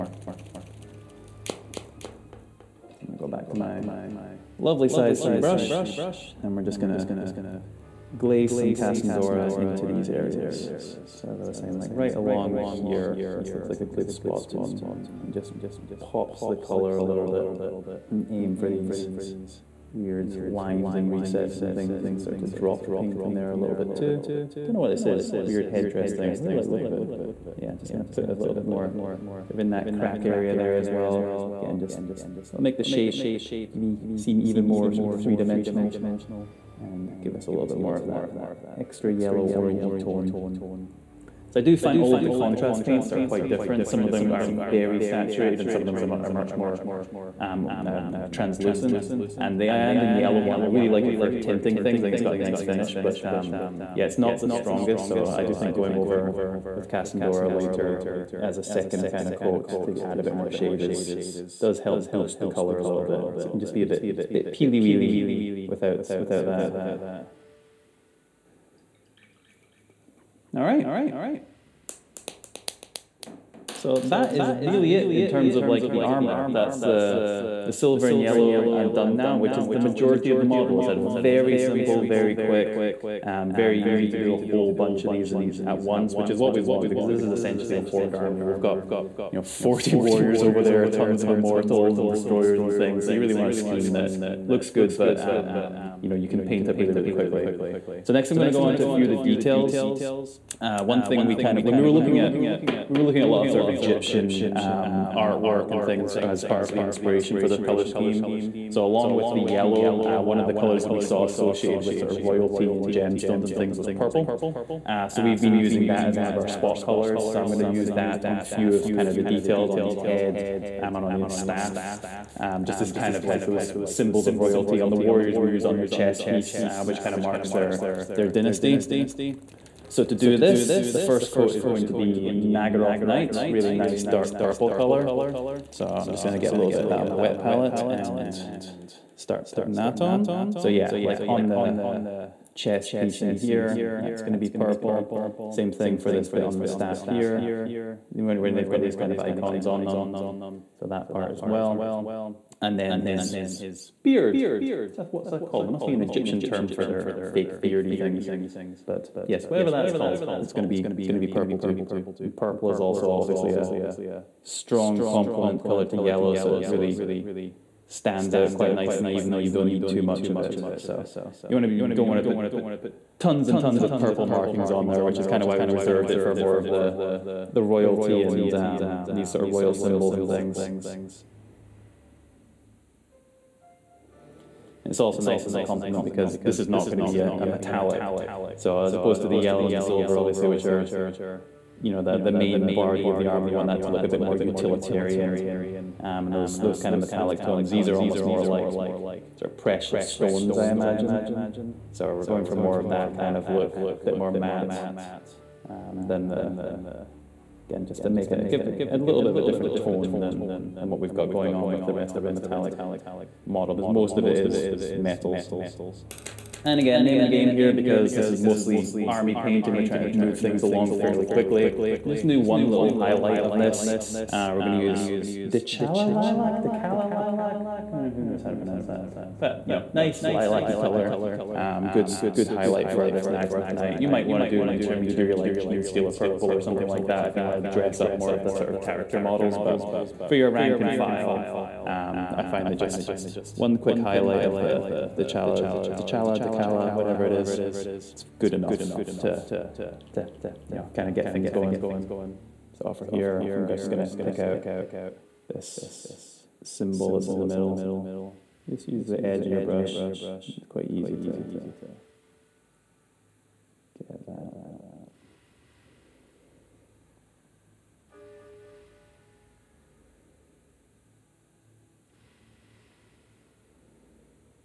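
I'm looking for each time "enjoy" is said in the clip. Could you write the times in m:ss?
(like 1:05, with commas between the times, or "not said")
not said.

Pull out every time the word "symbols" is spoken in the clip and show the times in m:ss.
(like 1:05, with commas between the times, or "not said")
2:03, 2:59, 4:16.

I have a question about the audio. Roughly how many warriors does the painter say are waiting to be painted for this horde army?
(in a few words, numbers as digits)
40.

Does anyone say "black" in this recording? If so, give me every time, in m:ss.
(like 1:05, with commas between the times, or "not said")
not said.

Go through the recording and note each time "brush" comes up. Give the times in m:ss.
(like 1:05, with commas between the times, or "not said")
0:05, 4:19.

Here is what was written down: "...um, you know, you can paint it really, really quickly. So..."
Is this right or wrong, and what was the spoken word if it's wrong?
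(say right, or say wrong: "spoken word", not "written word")
right.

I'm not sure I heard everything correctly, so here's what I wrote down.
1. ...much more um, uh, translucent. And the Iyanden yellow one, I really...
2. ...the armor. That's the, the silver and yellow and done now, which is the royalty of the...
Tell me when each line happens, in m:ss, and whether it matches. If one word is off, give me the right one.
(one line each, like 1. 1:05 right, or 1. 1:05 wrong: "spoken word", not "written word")
1. 0:46 right
2. 1:15 wrong: "majority", not "royalty".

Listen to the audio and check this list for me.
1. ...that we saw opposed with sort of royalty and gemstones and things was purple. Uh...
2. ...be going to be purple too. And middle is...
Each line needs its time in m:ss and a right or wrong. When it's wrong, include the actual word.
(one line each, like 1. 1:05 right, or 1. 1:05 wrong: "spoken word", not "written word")
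1. 1:50 wrong: "associated", not "opposed"
2. 2:40 wrong: "purple", not "middle".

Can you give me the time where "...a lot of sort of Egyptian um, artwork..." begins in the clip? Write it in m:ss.
1:43.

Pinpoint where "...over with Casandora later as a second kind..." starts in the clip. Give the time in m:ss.
0:55.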